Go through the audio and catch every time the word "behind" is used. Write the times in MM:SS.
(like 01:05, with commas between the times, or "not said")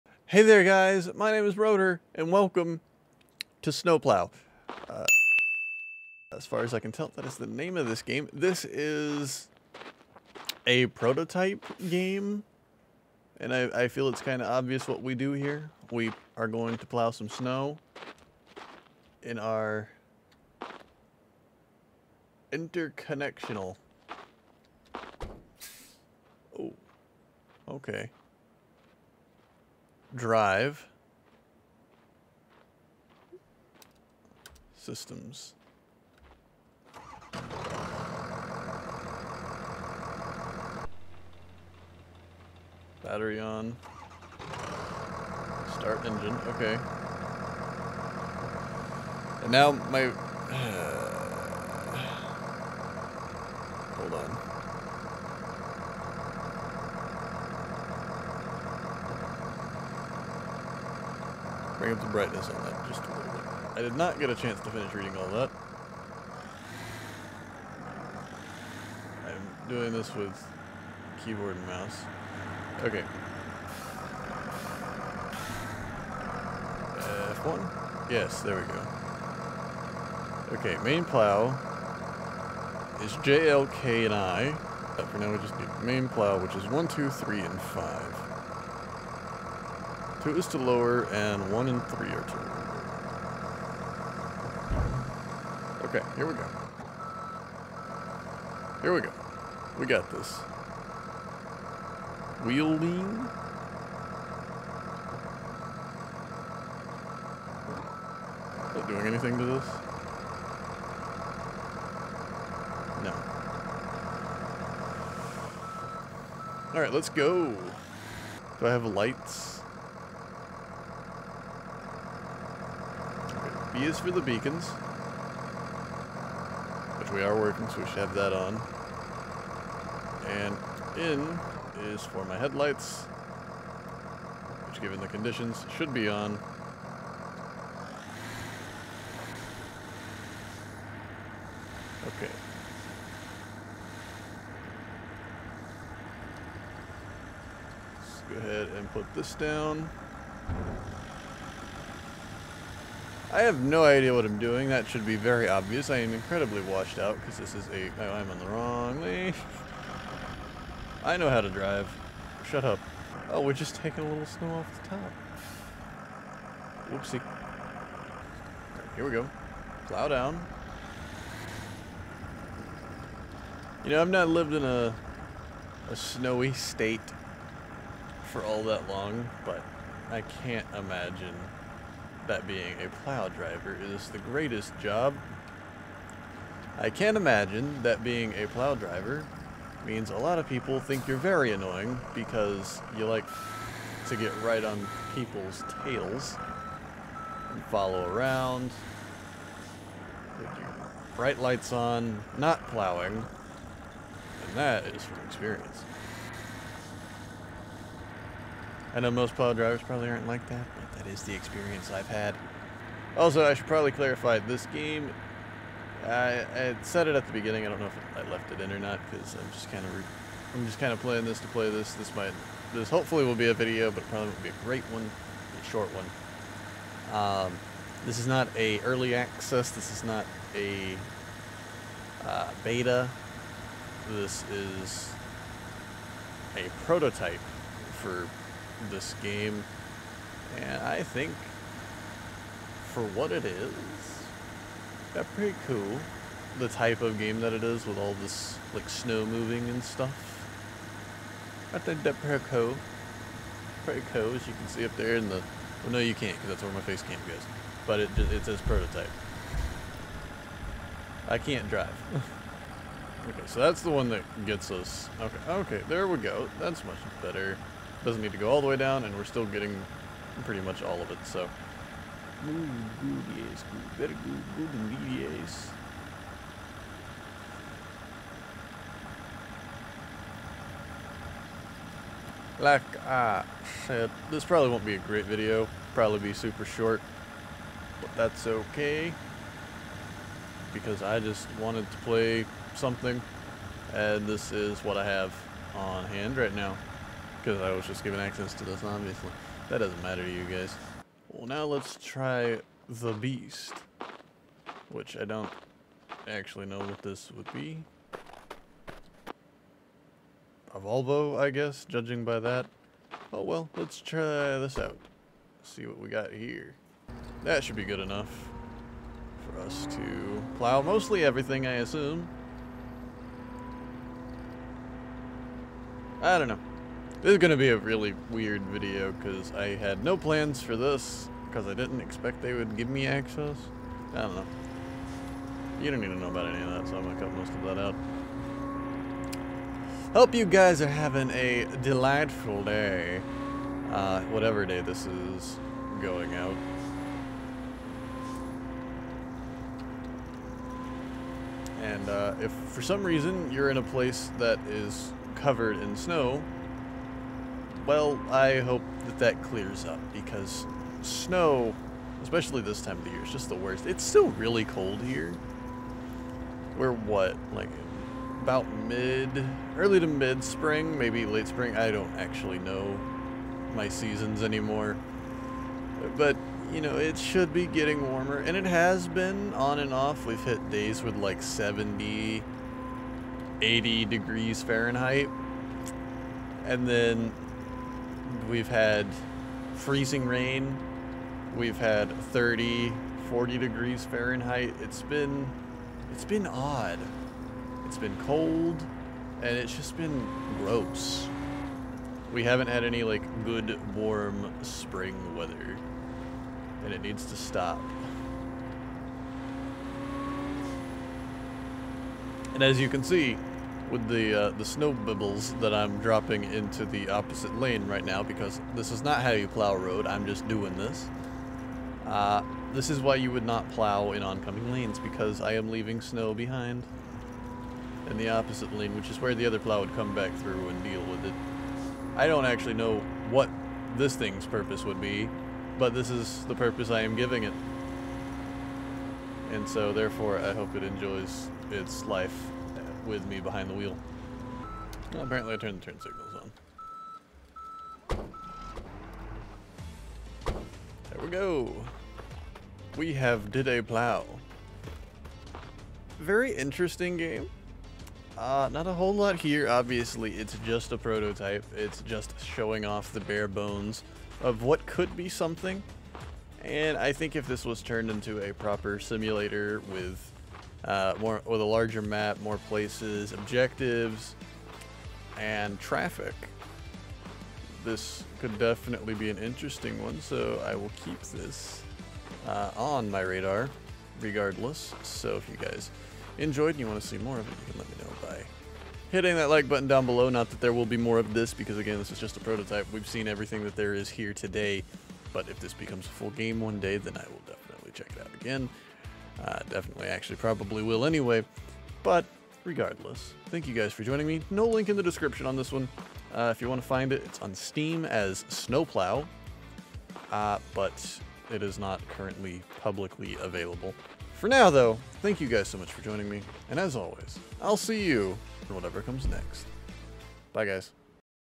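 07:06, 07:23.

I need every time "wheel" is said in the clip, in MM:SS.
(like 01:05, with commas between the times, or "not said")
01:42, 07:23.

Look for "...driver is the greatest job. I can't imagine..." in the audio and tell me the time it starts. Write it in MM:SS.
03:03.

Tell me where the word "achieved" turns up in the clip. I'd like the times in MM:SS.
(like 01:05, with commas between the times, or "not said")
not said.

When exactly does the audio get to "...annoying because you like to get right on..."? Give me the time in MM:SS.
03:11.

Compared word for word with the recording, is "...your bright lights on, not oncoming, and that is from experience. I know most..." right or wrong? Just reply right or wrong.
wrong.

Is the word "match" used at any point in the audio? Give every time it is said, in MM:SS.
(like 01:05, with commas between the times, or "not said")
not said.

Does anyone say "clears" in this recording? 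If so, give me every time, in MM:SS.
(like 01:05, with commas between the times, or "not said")
05:59.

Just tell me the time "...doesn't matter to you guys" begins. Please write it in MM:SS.
04:59.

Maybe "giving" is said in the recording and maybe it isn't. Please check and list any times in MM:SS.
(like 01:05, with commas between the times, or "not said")
07:17.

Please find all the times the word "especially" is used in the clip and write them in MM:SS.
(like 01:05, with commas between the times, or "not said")
06:02.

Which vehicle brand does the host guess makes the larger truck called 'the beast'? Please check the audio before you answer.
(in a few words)
Volvo.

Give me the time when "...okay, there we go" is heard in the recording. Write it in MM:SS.
04:25.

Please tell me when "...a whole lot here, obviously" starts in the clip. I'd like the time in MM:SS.
07:38.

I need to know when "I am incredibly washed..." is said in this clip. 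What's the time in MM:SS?
02:35.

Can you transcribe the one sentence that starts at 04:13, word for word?
Pretty cool, as you can see up there in the.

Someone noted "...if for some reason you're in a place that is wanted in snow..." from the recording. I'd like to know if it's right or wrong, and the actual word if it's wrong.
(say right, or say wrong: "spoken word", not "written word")
wrong: "covered", not "wanted".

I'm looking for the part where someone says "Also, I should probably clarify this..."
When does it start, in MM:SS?
03:33.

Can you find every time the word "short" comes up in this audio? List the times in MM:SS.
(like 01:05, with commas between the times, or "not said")
03:45, 04:46.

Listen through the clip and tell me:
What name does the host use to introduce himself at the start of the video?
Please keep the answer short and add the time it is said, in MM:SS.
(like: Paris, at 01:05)
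Rodor, at 00:01.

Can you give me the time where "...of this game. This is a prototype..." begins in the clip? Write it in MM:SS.
00:07.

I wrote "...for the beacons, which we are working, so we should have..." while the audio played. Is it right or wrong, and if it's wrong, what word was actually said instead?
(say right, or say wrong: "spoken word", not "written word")
right.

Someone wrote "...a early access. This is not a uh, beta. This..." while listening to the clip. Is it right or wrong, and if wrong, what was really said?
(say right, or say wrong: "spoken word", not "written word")
right.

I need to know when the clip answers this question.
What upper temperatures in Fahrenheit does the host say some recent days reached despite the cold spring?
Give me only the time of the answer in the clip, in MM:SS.
06:21.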